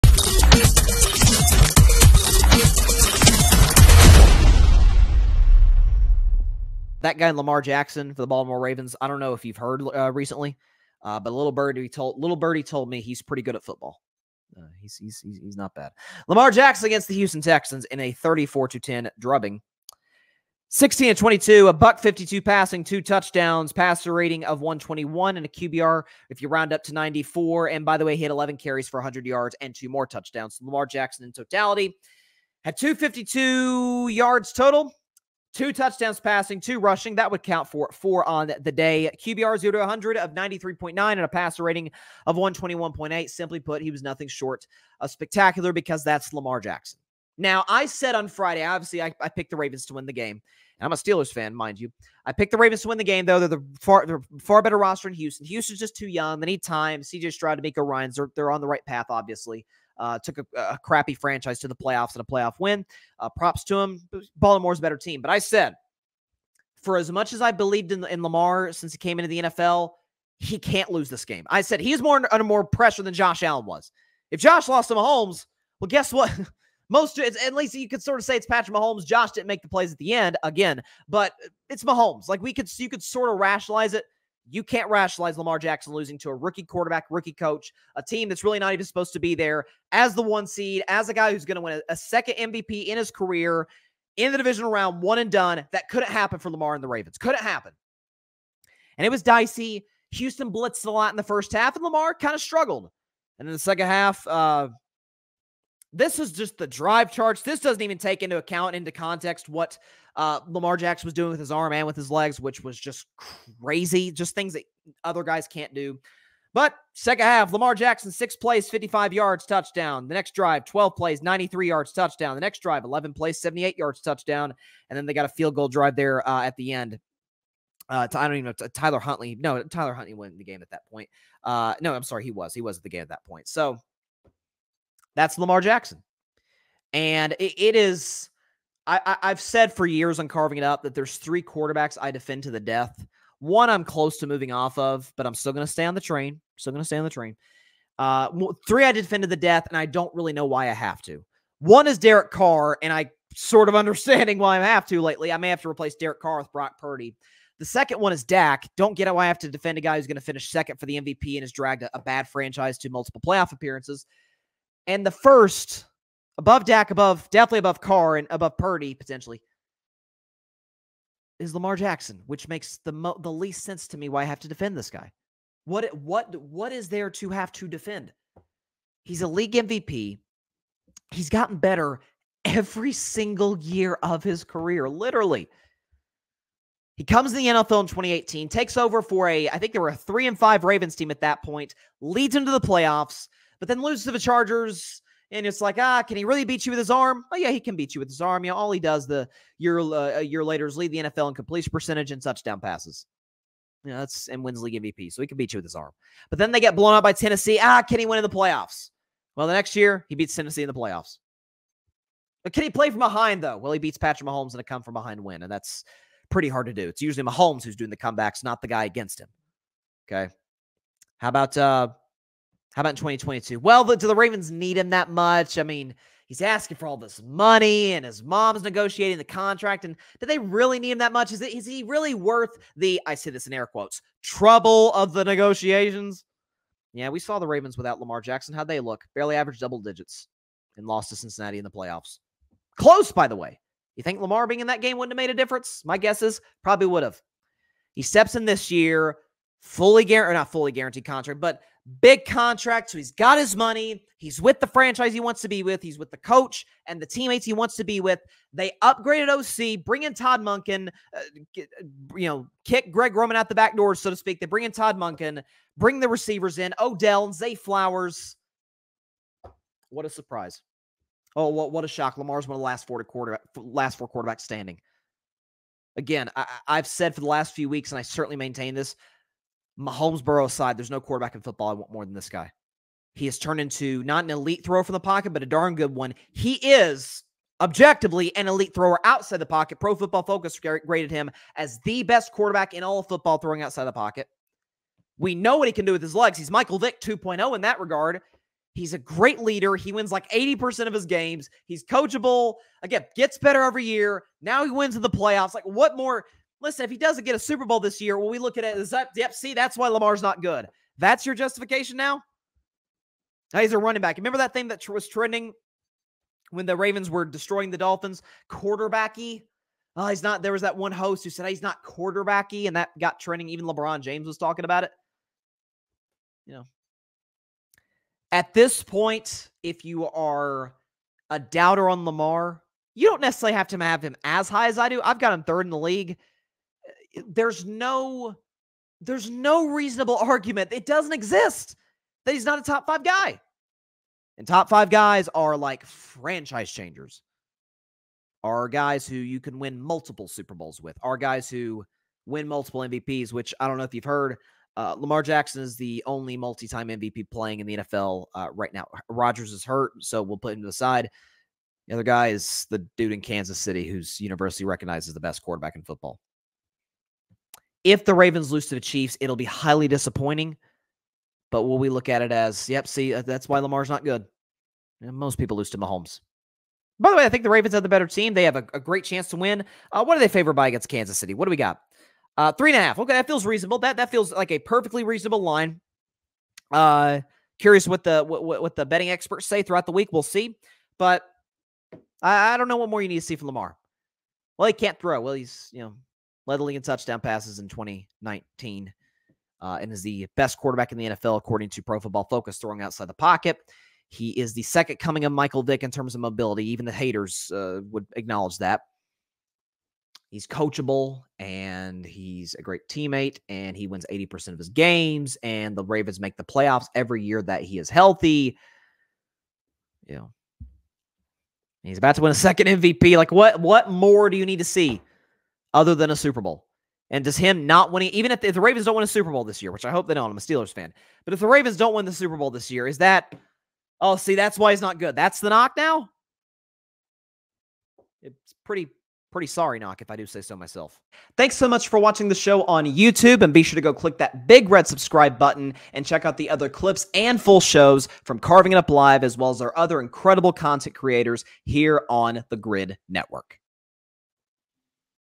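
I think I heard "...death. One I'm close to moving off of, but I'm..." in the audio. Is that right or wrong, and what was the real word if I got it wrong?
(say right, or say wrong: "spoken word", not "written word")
right.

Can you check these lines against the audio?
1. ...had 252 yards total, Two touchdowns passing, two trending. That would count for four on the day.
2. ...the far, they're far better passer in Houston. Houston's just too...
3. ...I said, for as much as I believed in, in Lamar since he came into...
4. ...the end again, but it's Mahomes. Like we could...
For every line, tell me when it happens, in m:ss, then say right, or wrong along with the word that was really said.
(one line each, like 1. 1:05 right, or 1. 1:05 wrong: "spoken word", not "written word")
1. 0:32 wrong: "rushing", not "trending"
2. 0:53 wrong: "roster", not "passer"
3. 1:05 right
4. 1:19 right.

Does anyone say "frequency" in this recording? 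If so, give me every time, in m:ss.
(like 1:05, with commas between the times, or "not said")
not said.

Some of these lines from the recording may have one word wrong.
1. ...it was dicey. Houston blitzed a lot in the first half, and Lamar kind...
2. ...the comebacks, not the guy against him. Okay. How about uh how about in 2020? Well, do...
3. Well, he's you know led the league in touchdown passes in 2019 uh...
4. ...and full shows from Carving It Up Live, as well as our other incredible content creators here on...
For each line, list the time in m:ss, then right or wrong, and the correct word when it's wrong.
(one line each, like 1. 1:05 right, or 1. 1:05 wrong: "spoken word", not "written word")
1. 1:39 right
2. 3:37 wrong: "2022", not "2020"
3. 6:35 right
4. 7:27 right.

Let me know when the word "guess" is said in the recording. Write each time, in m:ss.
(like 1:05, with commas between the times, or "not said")
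1:15, 4:05.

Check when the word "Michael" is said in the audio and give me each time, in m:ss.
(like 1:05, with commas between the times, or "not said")
4:56, 6:45.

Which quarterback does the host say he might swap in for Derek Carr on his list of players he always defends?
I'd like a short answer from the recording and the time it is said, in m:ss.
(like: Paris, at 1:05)
Brock Purdy, at 2:36.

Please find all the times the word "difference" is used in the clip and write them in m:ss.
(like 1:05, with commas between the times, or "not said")
4:05.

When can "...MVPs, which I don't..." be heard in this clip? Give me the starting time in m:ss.
5:52.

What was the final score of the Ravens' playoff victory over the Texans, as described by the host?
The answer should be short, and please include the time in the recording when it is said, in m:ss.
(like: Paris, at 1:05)
34 to 10, at 0:18.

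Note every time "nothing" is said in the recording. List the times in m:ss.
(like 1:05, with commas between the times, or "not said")
0:44.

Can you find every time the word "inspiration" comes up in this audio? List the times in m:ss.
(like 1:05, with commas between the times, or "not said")
not said.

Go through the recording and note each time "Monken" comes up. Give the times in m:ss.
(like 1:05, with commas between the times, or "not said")
4:20, 4:24.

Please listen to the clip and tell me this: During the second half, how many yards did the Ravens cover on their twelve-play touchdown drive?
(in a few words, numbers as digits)
93.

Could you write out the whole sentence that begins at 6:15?
And most people lose to Mahomes.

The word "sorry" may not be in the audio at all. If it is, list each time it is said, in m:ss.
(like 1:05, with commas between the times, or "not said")
2:12, 7:19.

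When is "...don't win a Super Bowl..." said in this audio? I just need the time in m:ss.
7:08.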